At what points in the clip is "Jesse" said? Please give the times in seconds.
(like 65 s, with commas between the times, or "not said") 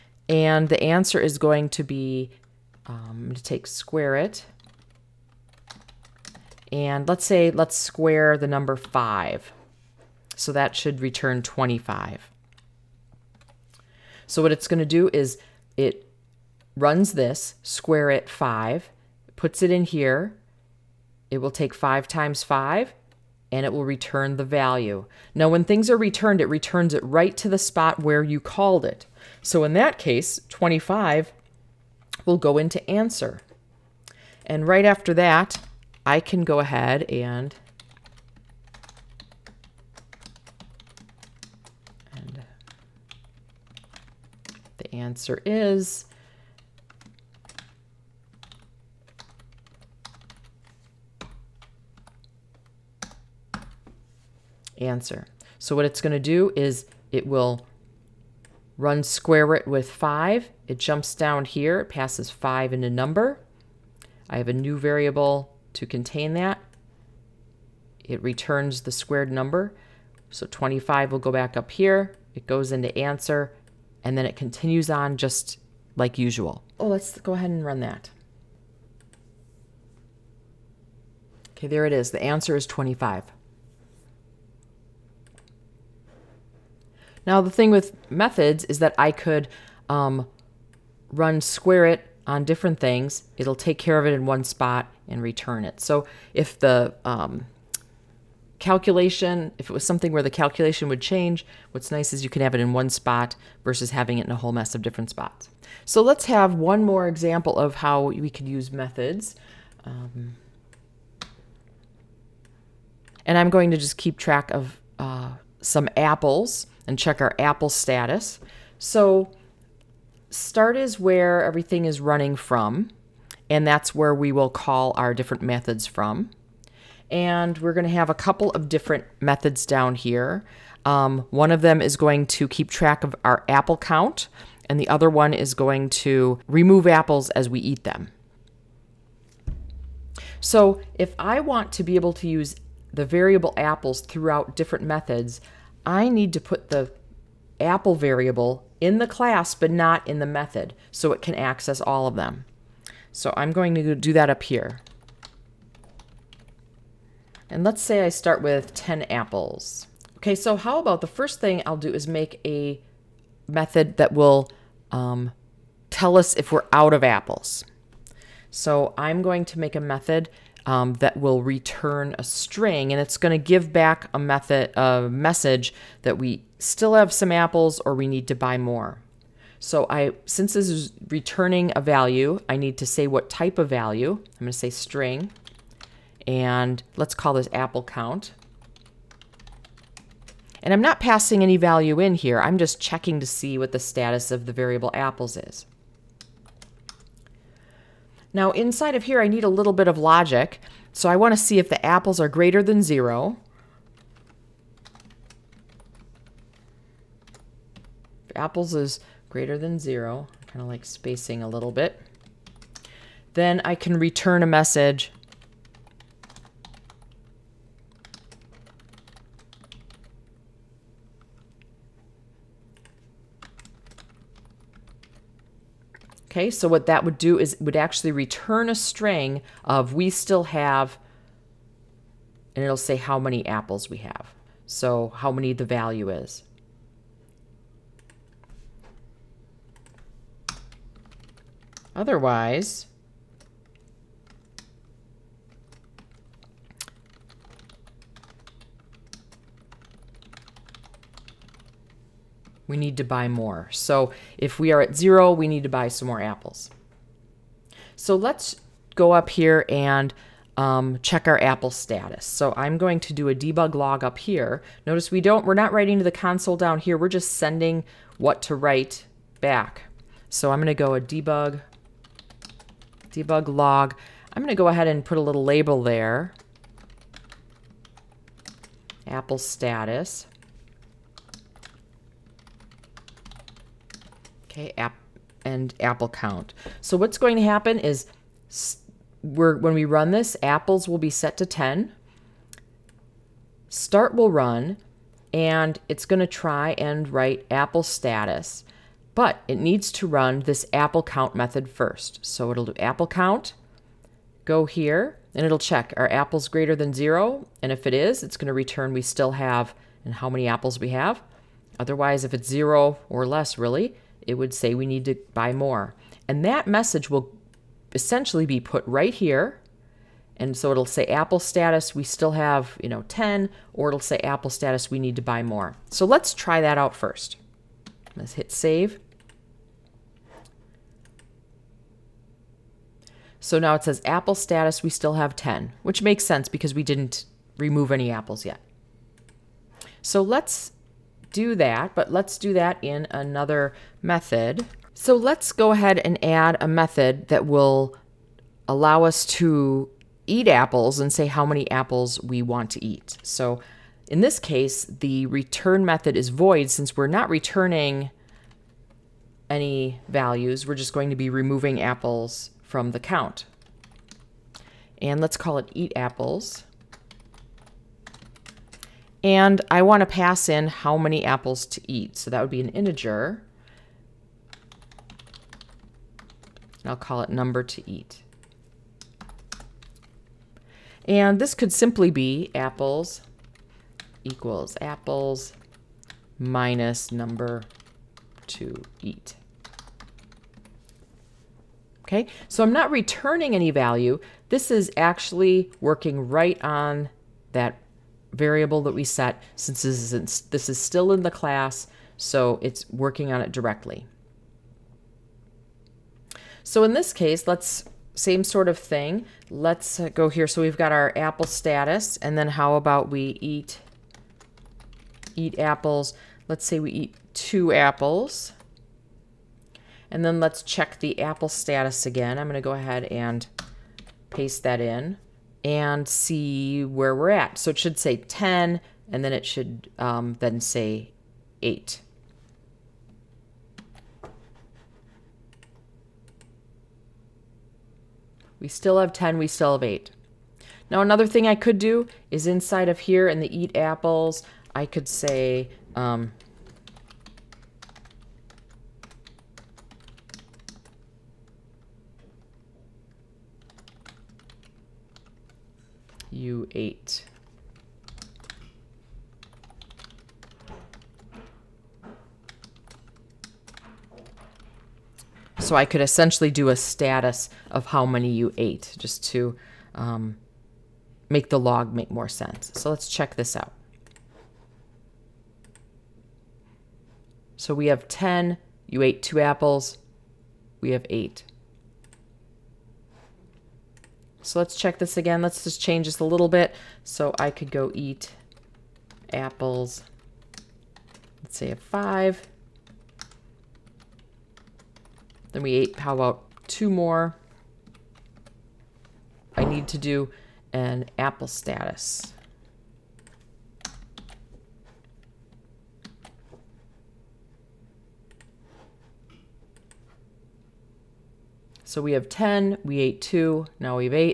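not said.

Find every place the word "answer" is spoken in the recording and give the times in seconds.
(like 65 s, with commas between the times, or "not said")
0 s, 32 s, 44 s, 54 s, 72 s, 82 s.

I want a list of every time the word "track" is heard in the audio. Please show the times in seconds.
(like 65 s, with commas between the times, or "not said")
114 s, 132 s.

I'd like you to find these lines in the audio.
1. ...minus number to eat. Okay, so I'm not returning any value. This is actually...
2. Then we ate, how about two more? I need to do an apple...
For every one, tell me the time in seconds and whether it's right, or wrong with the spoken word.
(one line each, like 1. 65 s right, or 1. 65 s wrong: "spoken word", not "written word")
1. 386 s right
2. 495 s right.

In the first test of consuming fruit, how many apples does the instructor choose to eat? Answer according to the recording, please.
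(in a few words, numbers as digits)
2.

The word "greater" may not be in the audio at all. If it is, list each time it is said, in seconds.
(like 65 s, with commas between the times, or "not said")
202 s, 209 s, 306 s.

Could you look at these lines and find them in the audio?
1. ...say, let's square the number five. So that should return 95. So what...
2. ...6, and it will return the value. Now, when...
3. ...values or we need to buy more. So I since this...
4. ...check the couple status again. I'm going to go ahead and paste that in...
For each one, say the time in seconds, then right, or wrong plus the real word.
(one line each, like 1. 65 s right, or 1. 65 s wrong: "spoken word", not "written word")
1. 7 s wrong: "25", not "95"
2. 22 s wrong: "5", not "6"
3. 177 s wrong: "apples", not "values"
4. 420 s wrong: "apple", not "couple".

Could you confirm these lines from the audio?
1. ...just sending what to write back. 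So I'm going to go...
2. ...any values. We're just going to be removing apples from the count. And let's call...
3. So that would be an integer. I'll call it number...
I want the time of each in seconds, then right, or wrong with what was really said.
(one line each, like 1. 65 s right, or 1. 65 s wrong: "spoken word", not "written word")
1. 267 s right
2. 359 s right
3. 372 s right.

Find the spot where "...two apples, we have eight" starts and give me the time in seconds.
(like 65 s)
479 s.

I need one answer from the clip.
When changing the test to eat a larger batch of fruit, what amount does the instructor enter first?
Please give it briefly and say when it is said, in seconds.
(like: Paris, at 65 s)
5, at 491 s.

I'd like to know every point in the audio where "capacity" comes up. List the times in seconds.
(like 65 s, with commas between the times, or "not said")
not said.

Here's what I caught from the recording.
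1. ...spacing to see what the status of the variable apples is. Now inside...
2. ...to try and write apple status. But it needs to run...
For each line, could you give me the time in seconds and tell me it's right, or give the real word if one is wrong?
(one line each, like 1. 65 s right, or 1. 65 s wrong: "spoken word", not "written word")
1. 192 s wrong: "checking", not "spacing"
2. 296 s right.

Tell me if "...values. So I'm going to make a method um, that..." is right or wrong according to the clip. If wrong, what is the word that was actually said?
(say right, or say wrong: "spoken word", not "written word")
wrong: "apples", not "values".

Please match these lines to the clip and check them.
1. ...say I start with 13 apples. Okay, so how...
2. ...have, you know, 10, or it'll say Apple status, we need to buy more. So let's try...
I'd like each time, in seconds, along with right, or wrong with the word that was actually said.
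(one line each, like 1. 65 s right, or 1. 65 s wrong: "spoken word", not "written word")
1. 157 s wrong: "10", not "13"
2. 322 s right.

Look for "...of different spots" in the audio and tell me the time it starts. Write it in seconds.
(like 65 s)
104 s.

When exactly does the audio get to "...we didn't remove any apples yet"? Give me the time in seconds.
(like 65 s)
336 s.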